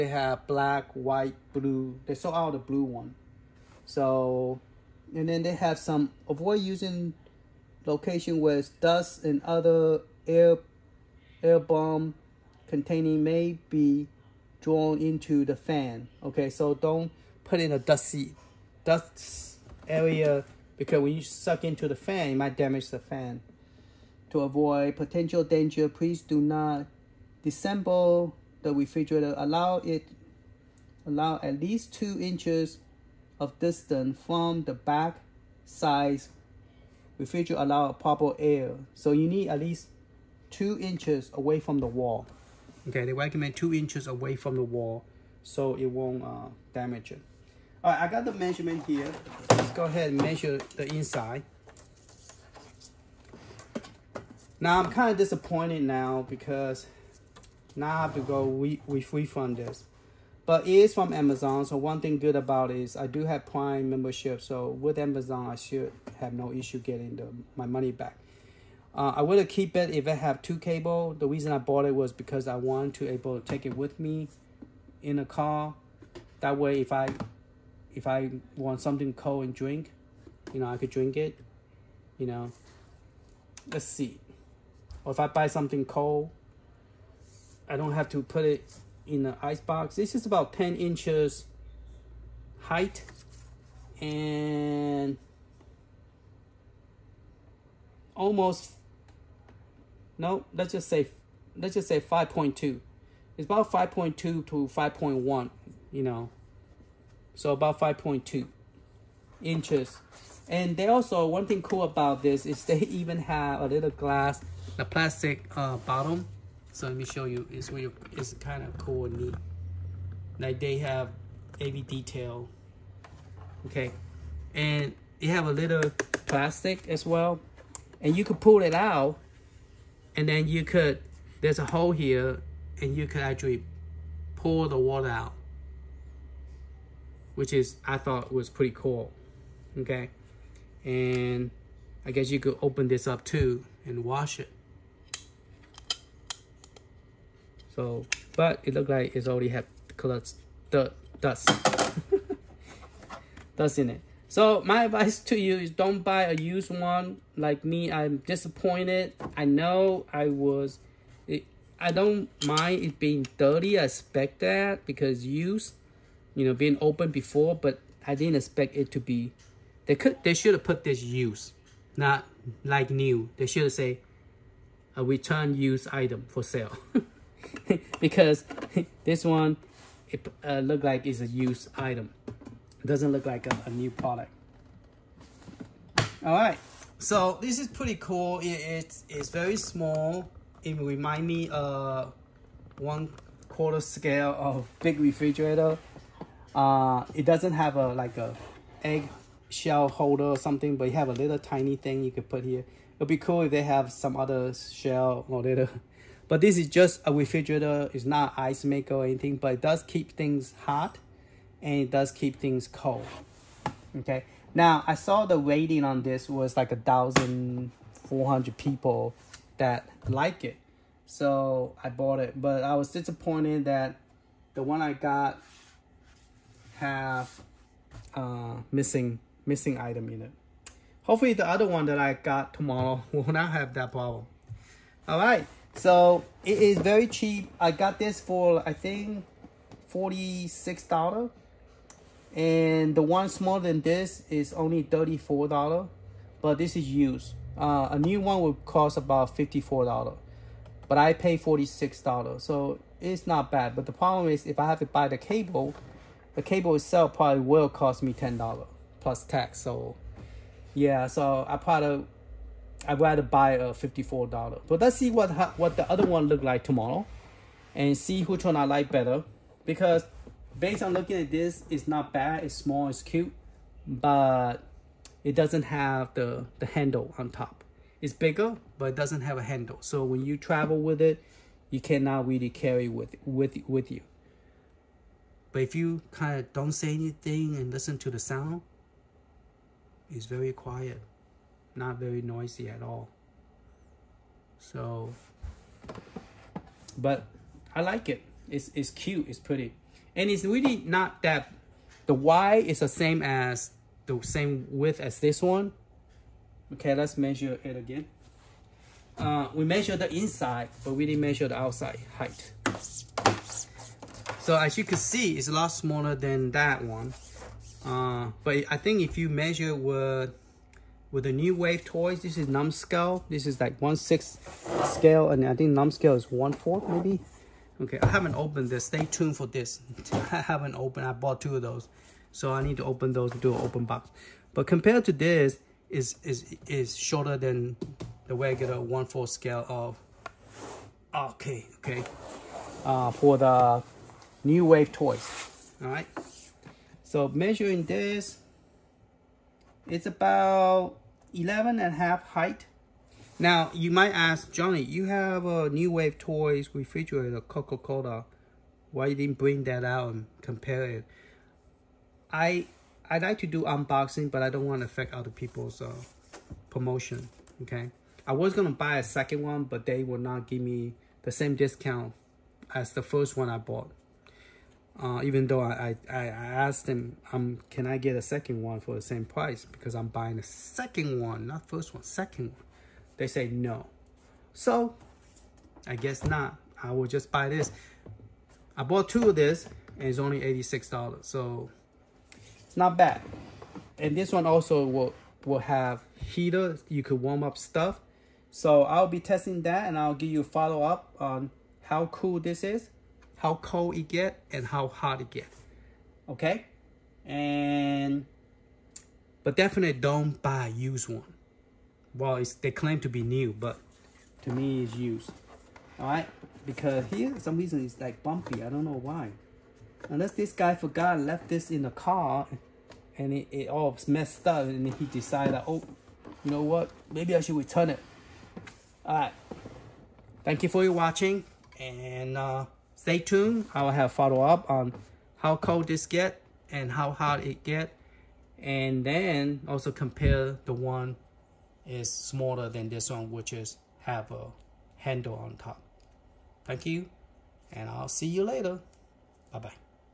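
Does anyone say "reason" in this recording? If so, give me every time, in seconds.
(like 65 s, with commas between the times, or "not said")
71 s, 417 s.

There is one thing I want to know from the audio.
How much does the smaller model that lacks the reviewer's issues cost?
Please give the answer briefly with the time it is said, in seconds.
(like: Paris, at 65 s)
$34, at 244 s.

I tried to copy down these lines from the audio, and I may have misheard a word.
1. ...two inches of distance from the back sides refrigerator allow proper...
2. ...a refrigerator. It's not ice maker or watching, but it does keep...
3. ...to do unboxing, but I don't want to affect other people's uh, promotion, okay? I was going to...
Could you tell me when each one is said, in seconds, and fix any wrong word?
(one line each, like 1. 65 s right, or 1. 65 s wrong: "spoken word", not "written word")
1. 31 s right
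2. 207 s wrong: "anything", not "watching"
3. 363 s right.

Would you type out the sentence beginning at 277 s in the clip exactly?
It's bigger, but it doesn't have a handle.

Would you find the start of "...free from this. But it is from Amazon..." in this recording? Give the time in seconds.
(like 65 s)
58 s.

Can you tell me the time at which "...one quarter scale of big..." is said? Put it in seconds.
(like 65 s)
192 s.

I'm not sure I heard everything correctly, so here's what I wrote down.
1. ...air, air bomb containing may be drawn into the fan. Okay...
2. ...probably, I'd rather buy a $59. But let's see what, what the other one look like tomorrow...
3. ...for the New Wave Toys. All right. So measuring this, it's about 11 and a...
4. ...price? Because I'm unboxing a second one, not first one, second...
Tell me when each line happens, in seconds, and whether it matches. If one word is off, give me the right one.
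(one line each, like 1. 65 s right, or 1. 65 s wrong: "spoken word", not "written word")
1. 10 s right
2. 261 s wrong: "54", not "59"
3. 343 s right
4. 379 s wrong: "buying", not "unboxing".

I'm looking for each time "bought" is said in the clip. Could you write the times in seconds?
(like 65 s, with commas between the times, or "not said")
71 s, 221 s, 331 s, 373 s, 388 s.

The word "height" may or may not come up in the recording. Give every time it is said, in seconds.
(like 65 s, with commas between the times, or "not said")
92 s, 312 s, 352 s.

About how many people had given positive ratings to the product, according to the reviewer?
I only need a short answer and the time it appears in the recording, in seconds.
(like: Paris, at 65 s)
1,400, at 216 s.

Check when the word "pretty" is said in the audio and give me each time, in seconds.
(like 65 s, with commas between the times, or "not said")
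138 s, 187 s, 299 s.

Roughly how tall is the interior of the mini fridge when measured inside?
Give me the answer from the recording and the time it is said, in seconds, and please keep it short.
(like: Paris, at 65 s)
10 inches, at 90 s.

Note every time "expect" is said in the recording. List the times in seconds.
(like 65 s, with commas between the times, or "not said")
163 s, 168 s.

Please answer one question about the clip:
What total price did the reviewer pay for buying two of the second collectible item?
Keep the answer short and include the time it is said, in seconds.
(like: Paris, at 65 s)
$86, at 390 s.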